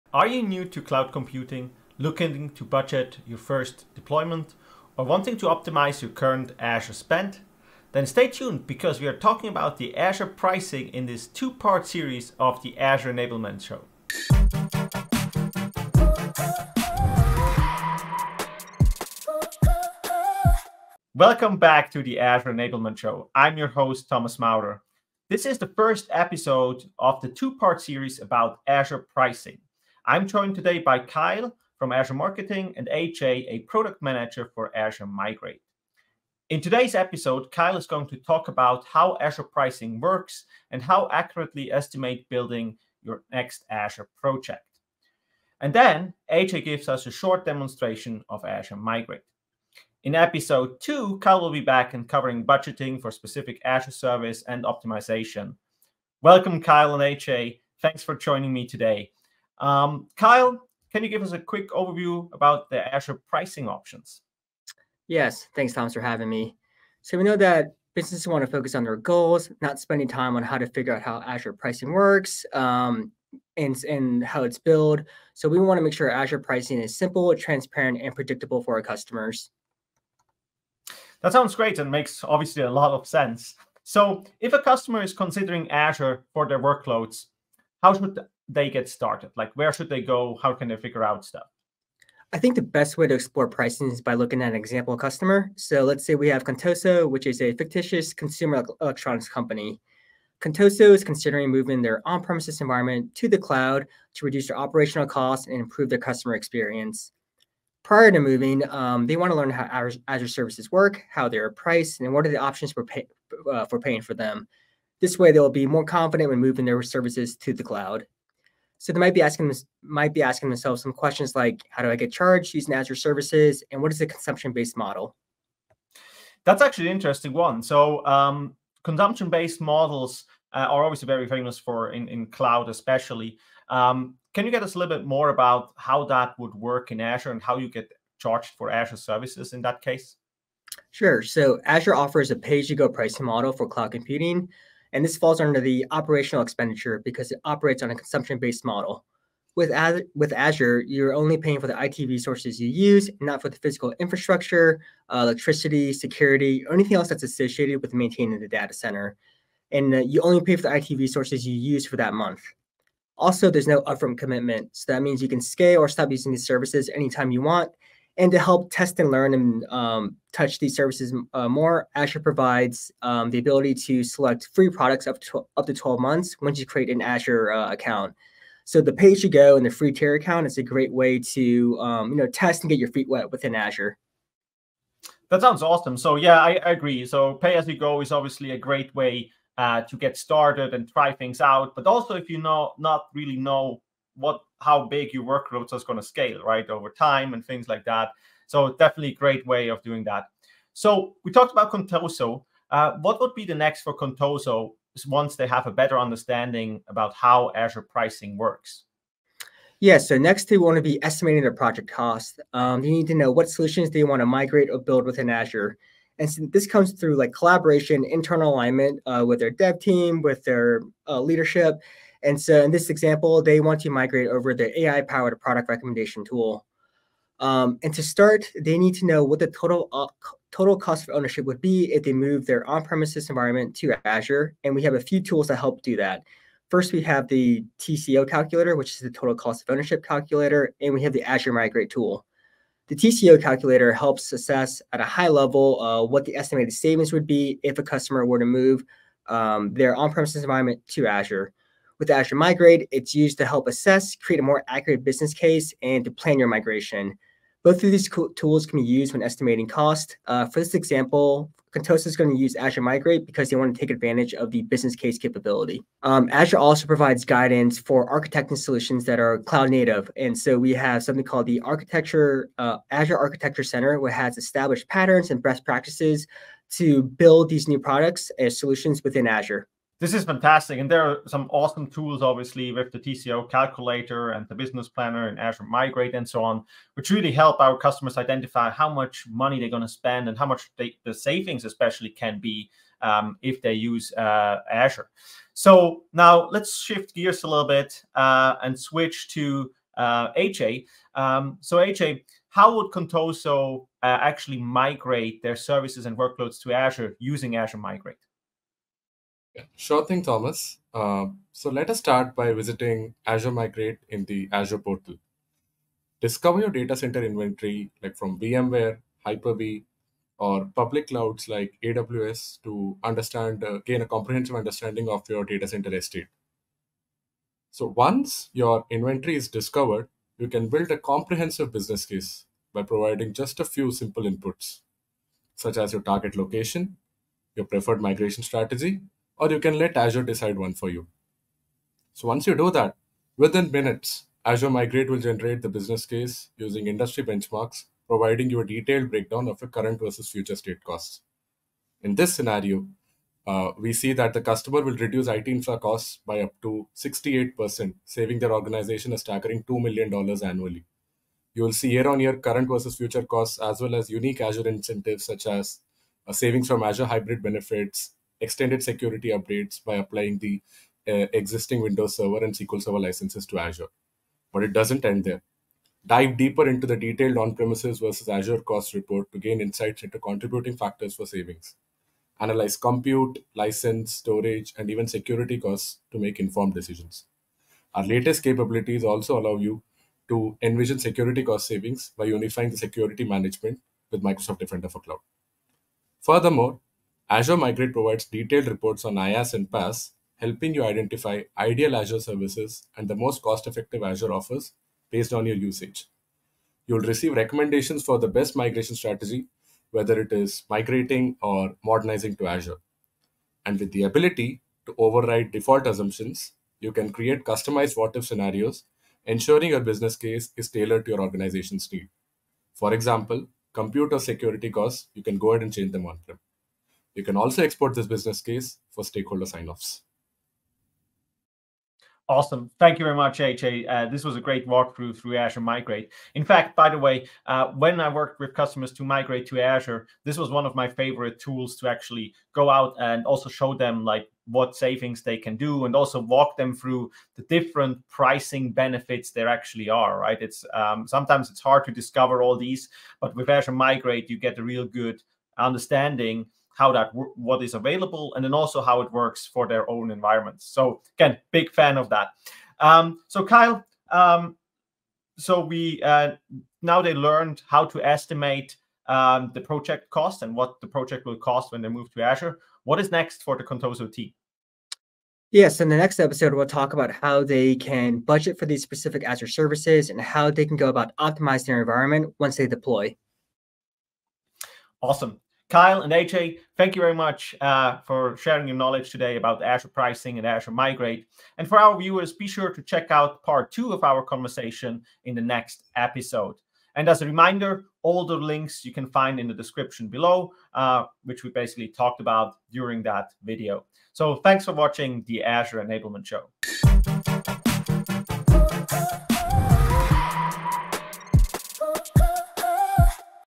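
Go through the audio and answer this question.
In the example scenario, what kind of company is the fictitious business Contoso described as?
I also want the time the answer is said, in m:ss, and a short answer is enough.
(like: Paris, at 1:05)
consumer electronics company, at 1:38.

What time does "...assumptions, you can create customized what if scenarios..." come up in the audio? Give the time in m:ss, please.
6:55.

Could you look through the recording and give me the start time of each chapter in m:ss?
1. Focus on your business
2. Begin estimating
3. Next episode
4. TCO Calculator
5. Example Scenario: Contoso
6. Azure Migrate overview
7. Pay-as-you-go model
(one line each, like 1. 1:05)
1. 1:07
2. 3:30
3. 7:55
4. 3:56
5. 1:32
6. 5:11
7. 2:21.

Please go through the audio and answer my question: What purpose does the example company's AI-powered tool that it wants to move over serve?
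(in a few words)
product recommendation.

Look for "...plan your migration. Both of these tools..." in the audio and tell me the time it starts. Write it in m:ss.
4:16.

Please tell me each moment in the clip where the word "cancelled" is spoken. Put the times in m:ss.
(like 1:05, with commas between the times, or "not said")
not said.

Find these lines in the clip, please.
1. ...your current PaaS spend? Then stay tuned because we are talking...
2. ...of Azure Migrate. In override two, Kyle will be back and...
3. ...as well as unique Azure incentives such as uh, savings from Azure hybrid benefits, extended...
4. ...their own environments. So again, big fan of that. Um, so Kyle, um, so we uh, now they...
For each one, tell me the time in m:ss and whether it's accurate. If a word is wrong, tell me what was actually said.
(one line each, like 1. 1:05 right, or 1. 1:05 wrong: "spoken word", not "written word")
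1. 0:06 wrong: "Azure", not "PaaS"
2. 0:48 wrong: "episode", not "override"
3. 6:03 right
4. 7:39 right.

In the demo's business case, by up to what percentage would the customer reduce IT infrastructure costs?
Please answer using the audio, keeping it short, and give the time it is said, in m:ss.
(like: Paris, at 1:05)
68%, at 5:56.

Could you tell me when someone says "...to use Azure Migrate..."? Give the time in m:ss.
4:22.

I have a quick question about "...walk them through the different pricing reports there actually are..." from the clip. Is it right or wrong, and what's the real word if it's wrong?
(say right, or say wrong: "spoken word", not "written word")
wrong: "benefits", not "reports".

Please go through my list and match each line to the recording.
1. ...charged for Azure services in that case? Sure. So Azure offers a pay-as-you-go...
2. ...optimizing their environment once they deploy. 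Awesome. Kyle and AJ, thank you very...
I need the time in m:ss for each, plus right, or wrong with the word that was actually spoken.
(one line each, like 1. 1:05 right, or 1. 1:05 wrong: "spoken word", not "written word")
1. 2:18 right
2. 8:01 right.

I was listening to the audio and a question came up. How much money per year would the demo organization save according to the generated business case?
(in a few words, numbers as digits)
$2 million.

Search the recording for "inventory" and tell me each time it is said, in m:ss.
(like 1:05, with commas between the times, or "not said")
5:17, 5:28.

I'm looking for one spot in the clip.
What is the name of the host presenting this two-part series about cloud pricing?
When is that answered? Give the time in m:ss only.
0:24.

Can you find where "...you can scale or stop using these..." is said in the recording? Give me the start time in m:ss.
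2:45.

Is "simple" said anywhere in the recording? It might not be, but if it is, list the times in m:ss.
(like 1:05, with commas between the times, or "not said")
1:16, 5:33.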